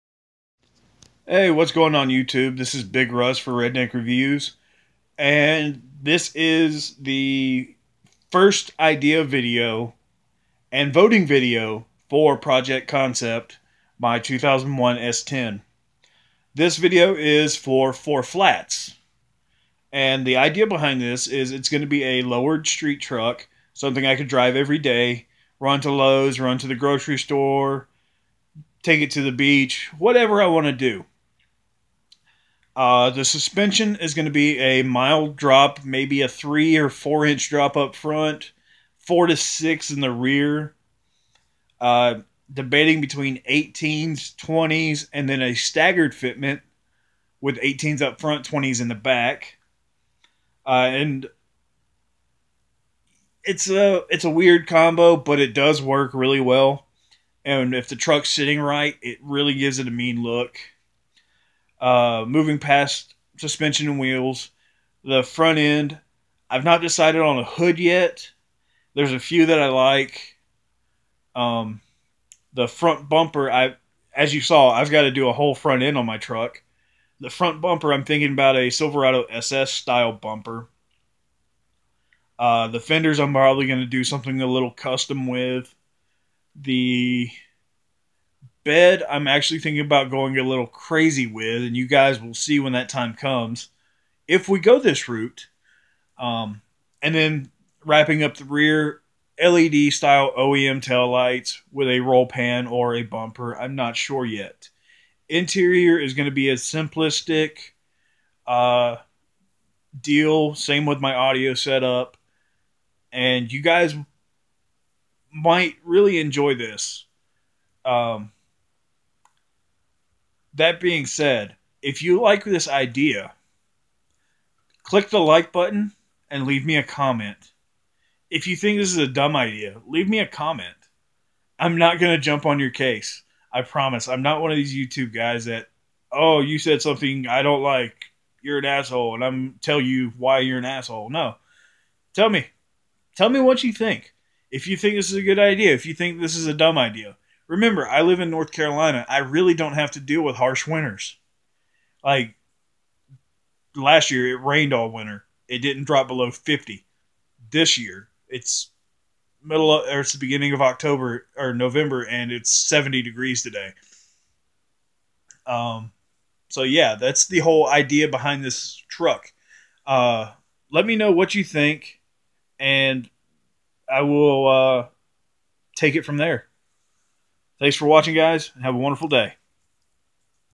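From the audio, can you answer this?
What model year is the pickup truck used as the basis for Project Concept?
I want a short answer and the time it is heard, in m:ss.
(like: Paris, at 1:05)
2001, at 0:14.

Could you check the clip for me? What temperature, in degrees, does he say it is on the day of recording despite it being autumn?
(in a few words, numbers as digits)
70.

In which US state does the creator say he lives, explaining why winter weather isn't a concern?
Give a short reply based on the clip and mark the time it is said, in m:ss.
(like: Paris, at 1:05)
North Carolina, at 2:28.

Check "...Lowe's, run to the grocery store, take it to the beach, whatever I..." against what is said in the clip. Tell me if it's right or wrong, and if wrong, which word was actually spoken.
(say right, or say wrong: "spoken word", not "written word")
right.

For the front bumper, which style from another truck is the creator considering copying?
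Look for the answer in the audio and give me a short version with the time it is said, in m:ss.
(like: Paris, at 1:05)
Silverado SS, at 1:18.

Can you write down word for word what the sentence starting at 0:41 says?
Uh, debating between 18s, 20s, and then a staggered fitment with 18s up front, 20s in the back.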